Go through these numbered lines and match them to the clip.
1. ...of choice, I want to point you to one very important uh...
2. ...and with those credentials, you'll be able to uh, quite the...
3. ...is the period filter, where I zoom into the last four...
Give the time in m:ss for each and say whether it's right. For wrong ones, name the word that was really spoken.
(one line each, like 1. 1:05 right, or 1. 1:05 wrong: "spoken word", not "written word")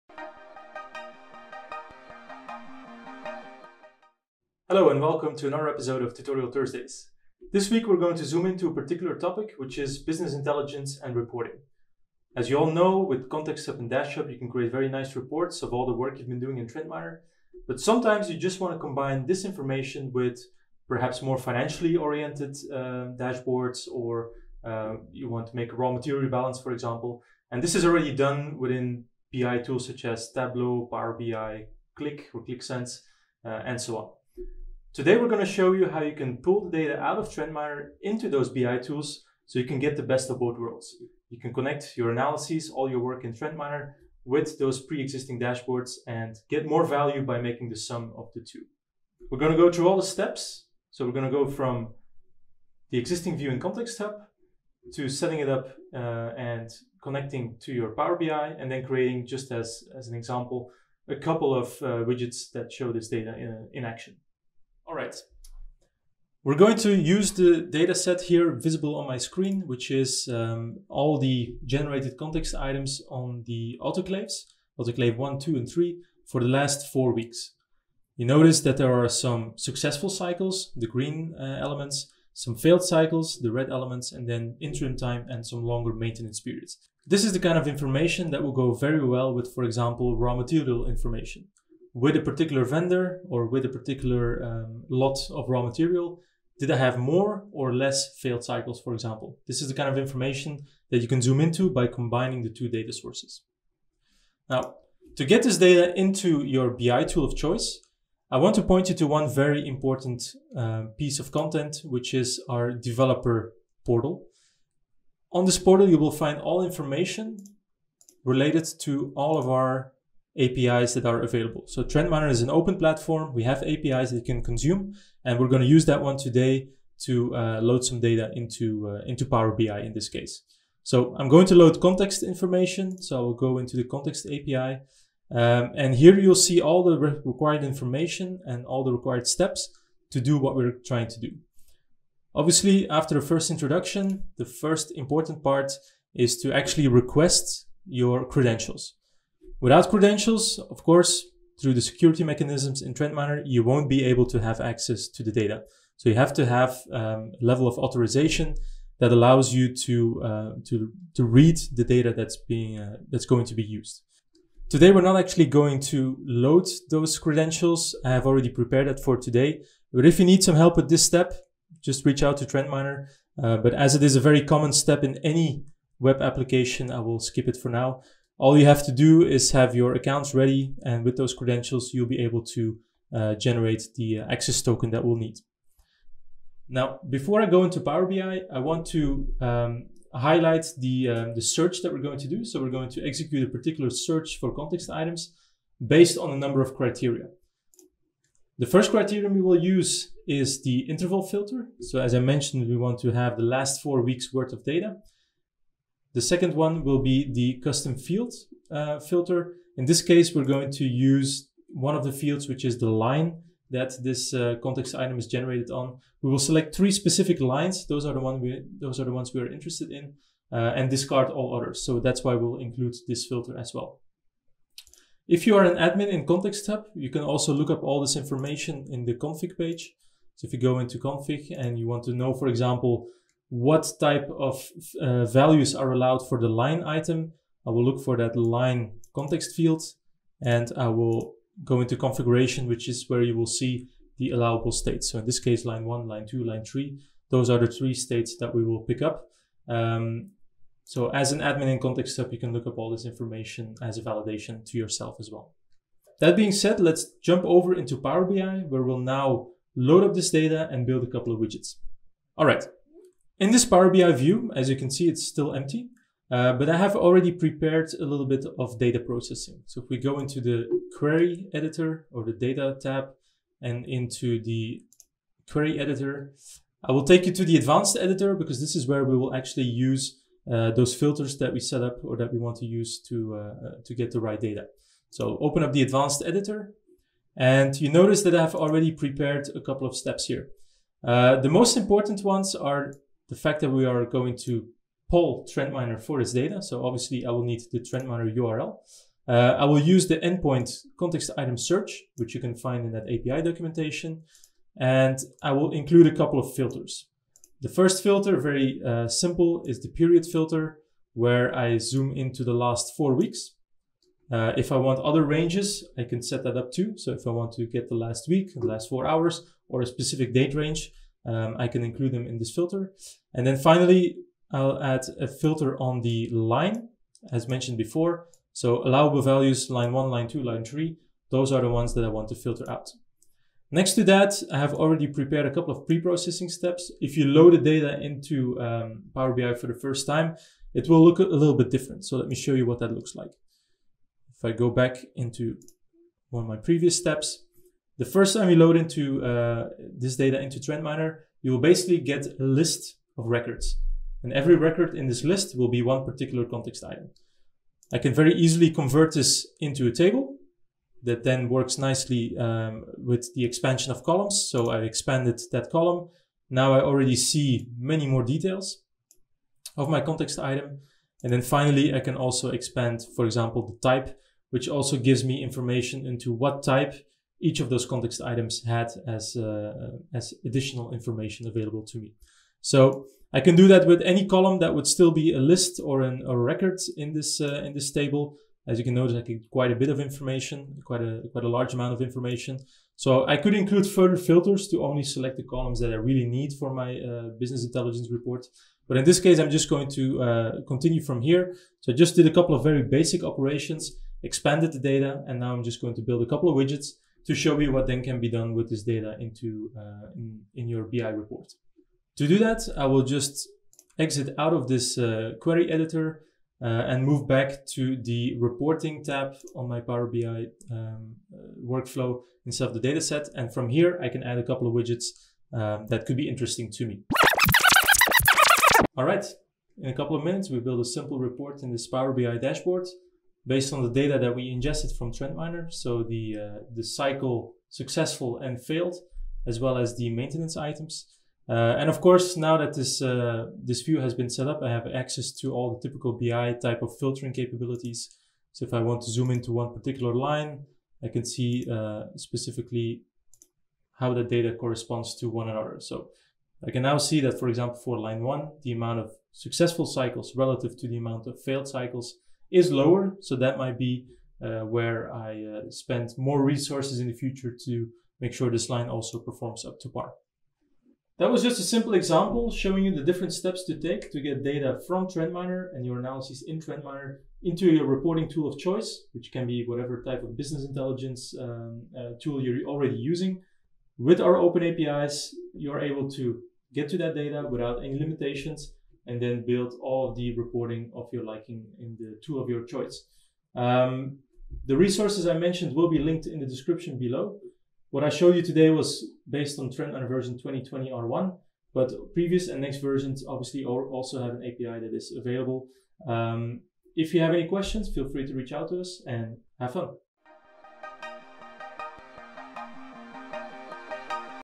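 1. 1:47 right
2. 3:00 wrong: "generate", not "quite"
3. 5:09 right.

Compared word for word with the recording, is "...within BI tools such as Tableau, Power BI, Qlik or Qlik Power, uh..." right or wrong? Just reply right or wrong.
wrong.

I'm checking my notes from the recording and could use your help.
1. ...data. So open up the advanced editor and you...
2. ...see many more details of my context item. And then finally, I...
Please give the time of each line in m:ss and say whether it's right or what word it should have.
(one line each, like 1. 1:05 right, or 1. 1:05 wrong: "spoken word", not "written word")
1. 4:44 right
2. 6:07 right.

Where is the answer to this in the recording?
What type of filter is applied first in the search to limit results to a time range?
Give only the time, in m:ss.
3:20.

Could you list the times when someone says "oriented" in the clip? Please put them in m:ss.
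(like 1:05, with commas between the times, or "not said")
0:21.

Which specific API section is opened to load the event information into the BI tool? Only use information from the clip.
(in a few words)
context API.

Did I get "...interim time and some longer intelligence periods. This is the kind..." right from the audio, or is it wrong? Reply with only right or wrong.
wrong.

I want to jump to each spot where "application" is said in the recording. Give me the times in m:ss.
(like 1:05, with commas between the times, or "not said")
2:56.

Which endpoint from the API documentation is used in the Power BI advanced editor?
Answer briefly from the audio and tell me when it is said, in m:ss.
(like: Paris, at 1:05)
context item search, at 5:00.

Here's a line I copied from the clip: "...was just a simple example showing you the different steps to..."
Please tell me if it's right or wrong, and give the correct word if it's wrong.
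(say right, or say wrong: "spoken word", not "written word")
right.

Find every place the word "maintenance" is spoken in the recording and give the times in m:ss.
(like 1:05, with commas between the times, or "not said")
1:25, 7:20.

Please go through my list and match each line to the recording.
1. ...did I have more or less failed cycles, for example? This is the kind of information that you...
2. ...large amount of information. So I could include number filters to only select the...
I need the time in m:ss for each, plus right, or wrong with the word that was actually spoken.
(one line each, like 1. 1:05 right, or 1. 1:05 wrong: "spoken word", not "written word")
1. 1:36 right
2. 6:31 wrong: "further", not "number".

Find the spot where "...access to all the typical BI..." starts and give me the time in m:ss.
7:24.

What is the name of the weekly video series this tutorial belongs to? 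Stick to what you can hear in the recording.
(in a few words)
Tutorial Thursdays.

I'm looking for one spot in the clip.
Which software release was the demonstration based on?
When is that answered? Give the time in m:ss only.
8:20.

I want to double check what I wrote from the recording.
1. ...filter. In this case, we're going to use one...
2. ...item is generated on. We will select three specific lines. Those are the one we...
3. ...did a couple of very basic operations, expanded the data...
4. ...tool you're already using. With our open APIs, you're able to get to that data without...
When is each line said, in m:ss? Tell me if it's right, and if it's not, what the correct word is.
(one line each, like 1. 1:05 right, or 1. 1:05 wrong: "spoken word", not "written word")
1. 3:28 right
2. 3:34 right
3. 6:42 right
4. 8:02 right.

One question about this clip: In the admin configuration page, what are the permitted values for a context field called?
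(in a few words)
allowable states.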